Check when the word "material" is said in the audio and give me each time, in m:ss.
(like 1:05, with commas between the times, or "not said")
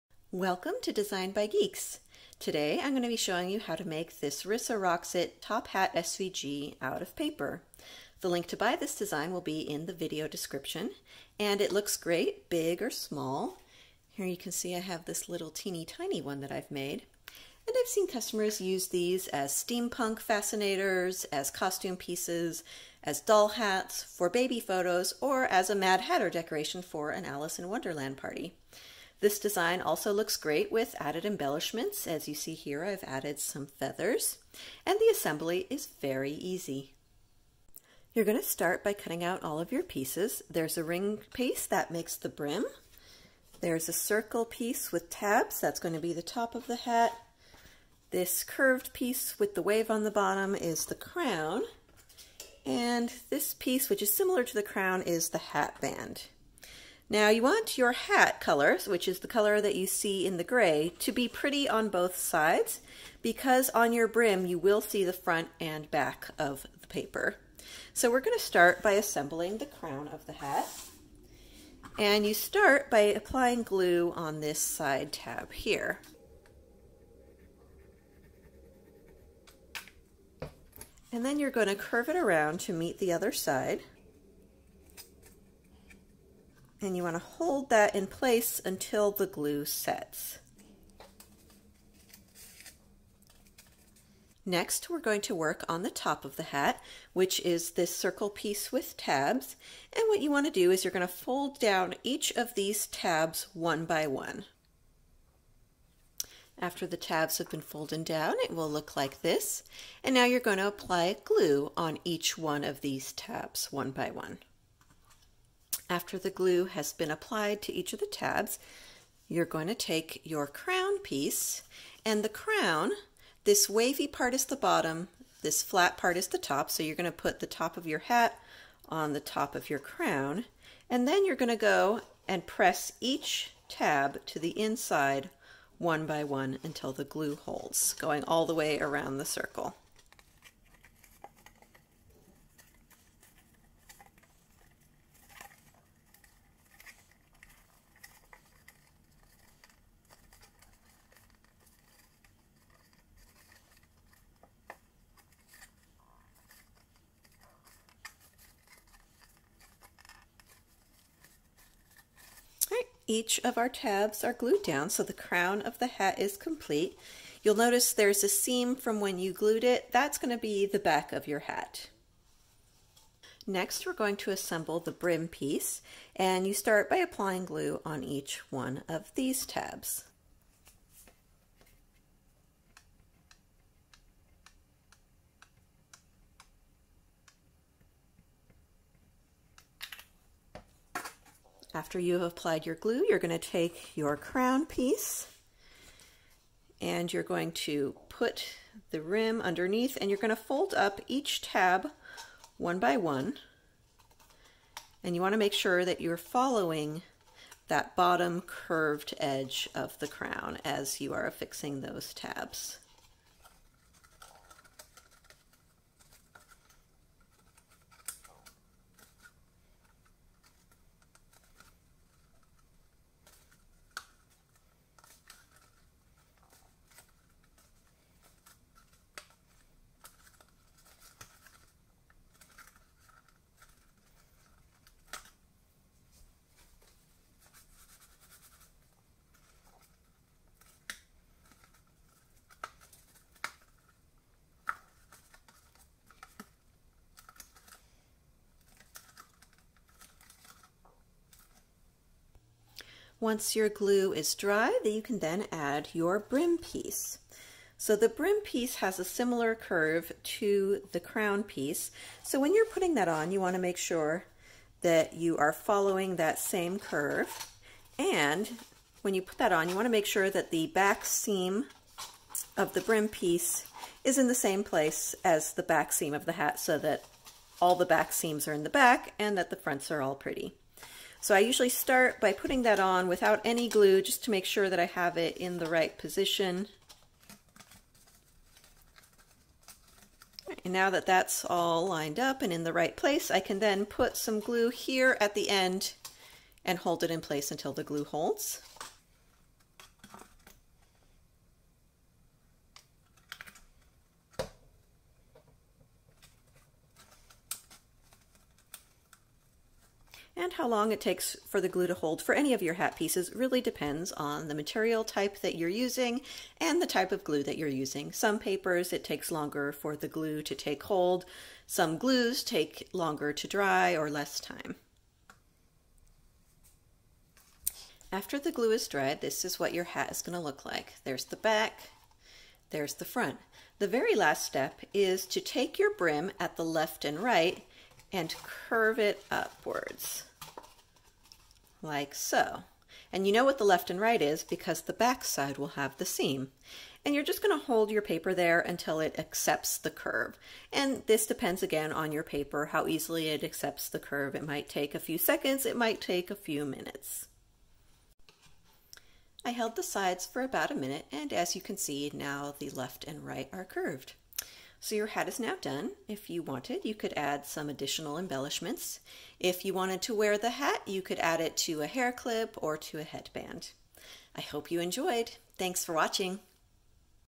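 5:14.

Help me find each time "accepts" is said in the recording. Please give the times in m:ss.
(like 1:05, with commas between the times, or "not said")
5:49, 5:53.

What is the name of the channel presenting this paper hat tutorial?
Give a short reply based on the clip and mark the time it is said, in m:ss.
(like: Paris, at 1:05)
Designed by Geeks, at 0:00.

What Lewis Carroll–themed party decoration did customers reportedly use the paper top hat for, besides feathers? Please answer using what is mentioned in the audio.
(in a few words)
Mad Hatter decoration.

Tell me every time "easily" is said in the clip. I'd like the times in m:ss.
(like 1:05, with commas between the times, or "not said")
5:52.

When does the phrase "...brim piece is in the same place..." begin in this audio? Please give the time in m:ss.
4:32.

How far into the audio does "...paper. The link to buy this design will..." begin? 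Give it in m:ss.
0:07.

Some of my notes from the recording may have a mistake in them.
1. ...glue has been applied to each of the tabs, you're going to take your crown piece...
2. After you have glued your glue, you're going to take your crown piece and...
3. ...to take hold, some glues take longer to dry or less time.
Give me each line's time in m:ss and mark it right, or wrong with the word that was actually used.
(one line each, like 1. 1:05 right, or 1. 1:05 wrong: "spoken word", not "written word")
1. 1:56 right
2. 3:11 wrong: "applied", not "glued"
3. 5:20 right.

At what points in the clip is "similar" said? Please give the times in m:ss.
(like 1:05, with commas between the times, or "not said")
0:54, 4:19.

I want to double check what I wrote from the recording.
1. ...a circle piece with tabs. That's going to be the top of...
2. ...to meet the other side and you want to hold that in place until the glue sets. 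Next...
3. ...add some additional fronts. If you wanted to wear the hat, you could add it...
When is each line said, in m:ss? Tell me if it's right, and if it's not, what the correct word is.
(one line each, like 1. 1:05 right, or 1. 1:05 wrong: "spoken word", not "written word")
1. 0:43 right
2. 1:22 right
3. 6:07 wrong: "embellishments", not "fronts".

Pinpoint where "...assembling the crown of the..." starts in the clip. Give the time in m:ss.
1:08.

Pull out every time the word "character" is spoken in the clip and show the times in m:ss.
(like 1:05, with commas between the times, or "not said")
not said.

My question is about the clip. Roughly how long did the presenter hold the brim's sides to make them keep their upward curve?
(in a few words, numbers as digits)
About a minute.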